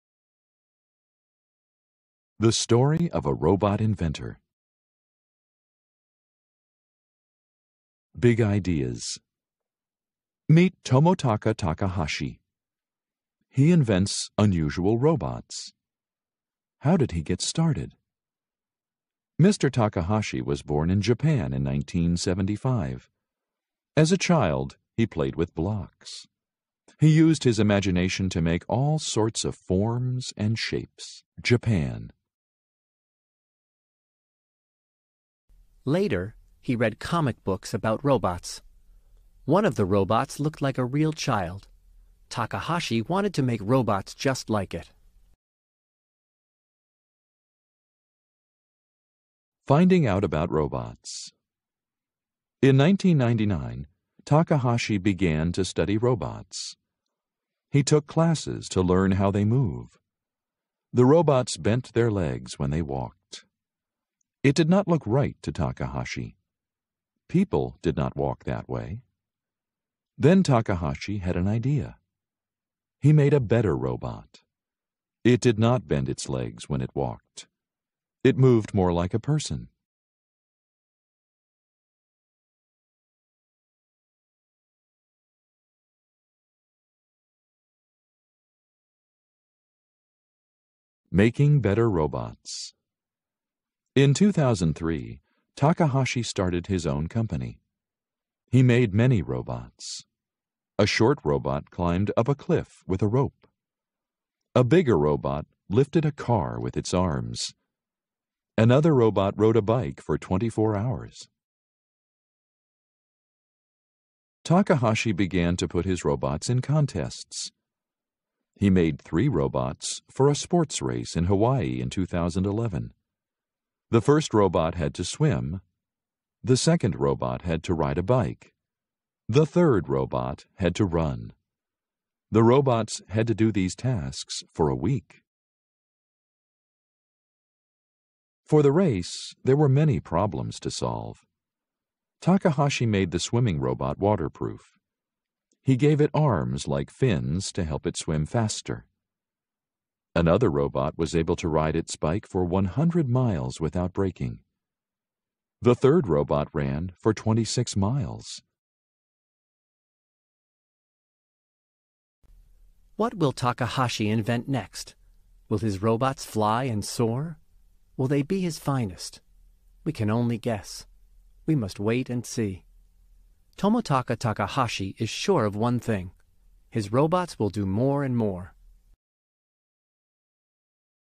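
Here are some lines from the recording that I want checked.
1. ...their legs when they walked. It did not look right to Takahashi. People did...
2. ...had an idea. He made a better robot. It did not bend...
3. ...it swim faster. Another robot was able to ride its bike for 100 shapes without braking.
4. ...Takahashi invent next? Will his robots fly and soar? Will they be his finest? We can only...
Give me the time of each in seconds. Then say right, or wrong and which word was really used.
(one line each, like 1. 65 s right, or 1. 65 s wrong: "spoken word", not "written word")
1. 61 s right
2. 71 s right
3. 147 s wrong: "miles", not "shapes"
4. 163 s right.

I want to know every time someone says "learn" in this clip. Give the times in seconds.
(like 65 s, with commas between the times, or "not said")
58 s.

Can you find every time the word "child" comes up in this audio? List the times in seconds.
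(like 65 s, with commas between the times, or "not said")
24 s, 41 s.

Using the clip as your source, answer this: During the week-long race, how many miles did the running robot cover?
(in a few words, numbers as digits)
26.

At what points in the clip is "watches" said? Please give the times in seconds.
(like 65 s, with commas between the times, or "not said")
not said.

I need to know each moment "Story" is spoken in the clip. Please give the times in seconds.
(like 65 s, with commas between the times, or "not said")
2 s.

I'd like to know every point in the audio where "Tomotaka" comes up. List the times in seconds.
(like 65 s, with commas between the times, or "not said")
10 s, 173 s.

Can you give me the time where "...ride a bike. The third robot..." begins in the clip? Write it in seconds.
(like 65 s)
127 s.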